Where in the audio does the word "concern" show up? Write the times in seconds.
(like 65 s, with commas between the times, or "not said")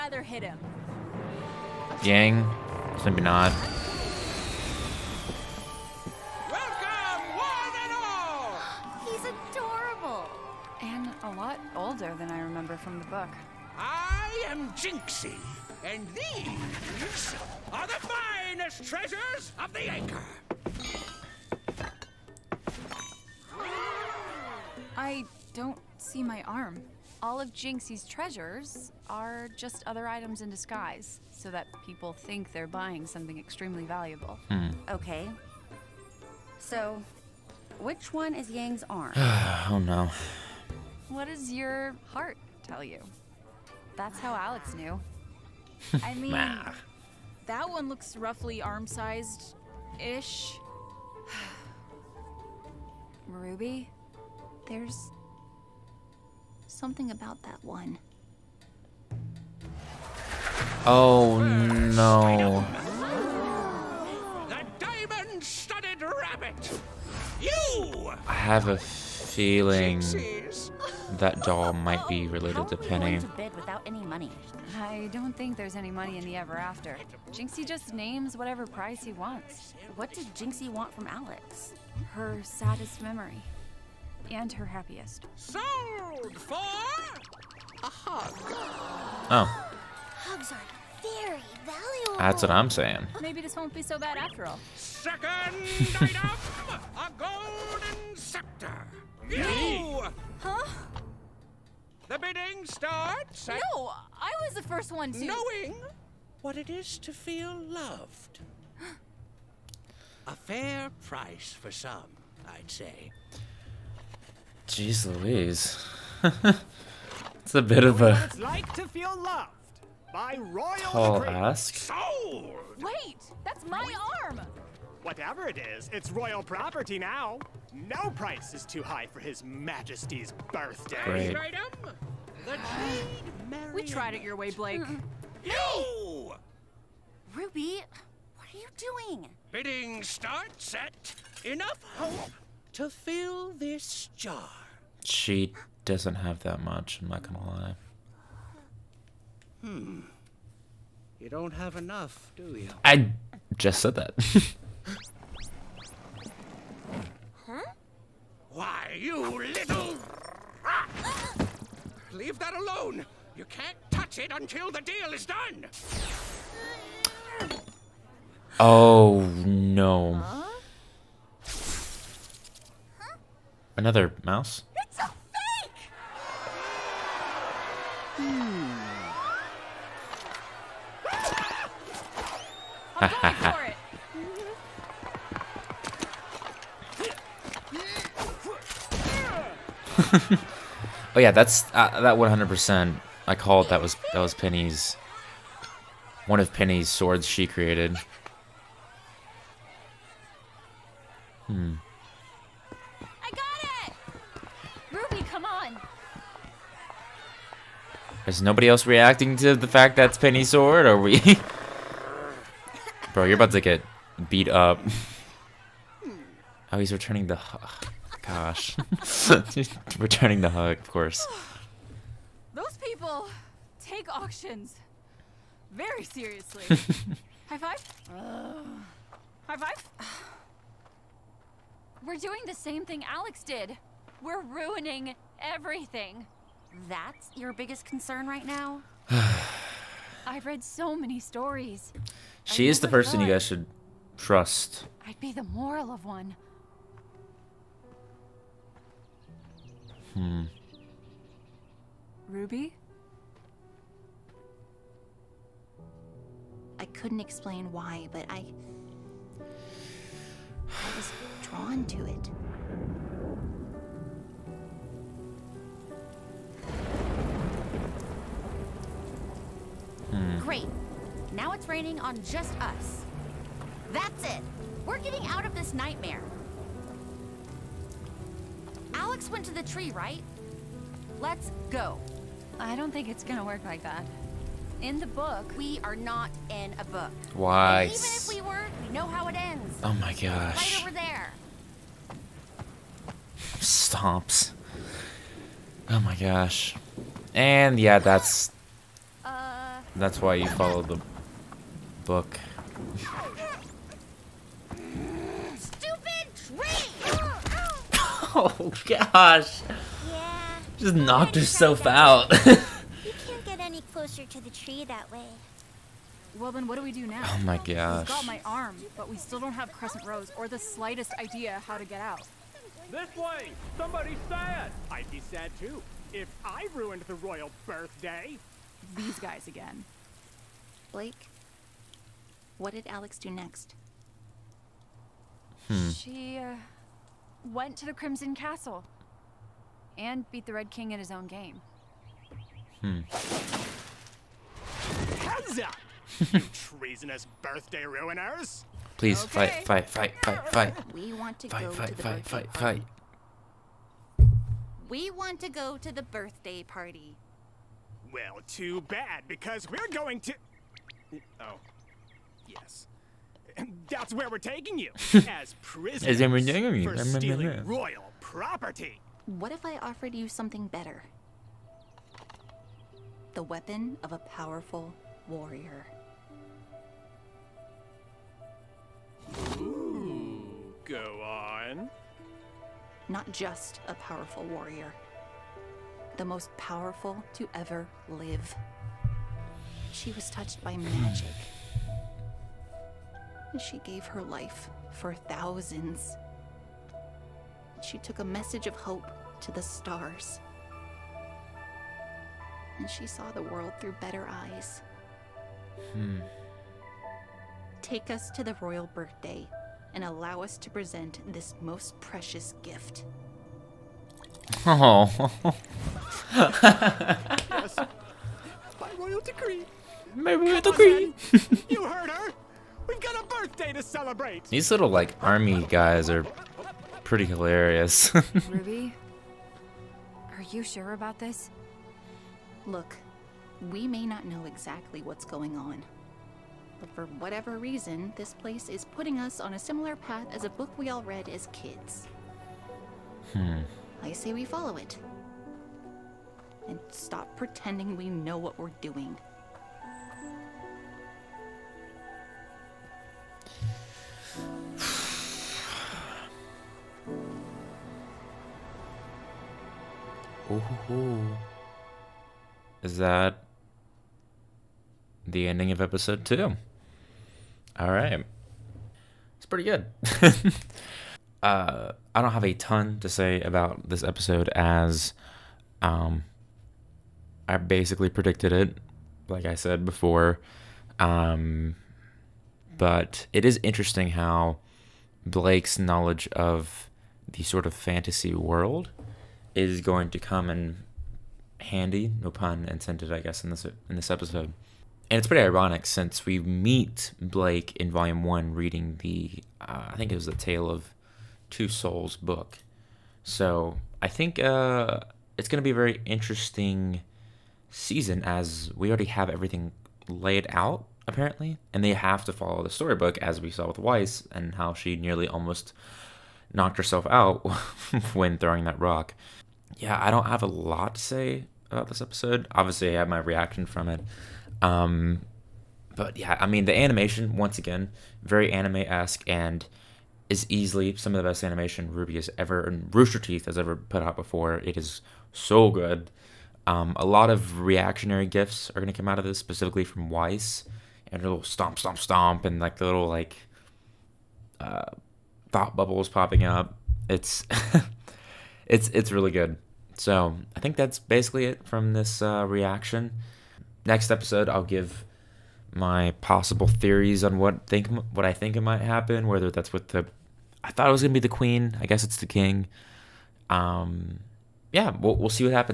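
237 s.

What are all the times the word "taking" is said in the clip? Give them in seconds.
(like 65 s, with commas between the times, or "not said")
364 s.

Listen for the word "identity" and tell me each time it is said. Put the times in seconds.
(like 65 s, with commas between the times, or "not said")
not said.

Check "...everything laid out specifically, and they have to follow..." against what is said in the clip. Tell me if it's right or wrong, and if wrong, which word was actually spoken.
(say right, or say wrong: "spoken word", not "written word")
wrong: "apparently", not "specifically".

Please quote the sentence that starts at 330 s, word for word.
Blake, what did Alyx do next?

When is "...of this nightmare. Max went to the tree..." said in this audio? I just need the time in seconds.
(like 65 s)
275 s.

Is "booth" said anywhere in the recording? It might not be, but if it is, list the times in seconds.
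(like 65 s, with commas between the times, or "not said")
not said.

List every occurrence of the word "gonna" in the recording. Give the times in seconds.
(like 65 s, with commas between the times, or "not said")
147 s, 283 s, 561 s.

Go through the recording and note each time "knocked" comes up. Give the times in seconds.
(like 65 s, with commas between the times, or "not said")
310 s, 516 s.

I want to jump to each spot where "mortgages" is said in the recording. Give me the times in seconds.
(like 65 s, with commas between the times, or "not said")
not said.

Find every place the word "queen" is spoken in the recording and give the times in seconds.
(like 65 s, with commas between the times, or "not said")
561 s.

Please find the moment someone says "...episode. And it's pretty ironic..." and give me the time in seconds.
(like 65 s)
494 s.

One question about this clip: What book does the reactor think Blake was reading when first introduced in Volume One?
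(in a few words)
Tale of Two Souls.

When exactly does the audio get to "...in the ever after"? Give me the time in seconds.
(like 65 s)
76 s.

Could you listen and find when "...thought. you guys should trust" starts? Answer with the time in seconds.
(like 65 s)
243 s.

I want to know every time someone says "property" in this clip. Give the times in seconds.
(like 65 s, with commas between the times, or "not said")
126 s, 368 s.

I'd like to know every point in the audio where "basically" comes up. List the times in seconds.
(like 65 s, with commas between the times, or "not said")
477 s, 550 s.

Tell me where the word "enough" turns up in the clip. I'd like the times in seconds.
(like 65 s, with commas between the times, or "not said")
141 s, 151 s.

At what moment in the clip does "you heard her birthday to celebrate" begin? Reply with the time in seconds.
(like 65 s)
421 s.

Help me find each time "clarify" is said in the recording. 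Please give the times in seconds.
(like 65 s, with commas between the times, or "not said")
not said.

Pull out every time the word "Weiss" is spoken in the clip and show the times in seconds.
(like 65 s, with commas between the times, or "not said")
513 s, 540 s.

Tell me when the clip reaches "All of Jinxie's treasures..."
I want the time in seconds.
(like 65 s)
27 s.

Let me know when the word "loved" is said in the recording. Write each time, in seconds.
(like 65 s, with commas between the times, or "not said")
107 s, 119 s.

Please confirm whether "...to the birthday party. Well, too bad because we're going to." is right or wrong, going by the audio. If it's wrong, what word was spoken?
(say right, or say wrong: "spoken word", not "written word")
right.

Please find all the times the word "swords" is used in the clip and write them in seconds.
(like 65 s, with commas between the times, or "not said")
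196 s, 210 s.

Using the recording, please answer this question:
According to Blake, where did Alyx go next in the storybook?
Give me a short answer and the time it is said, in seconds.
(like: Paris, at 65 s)
The Crimson Castle, at 337 s.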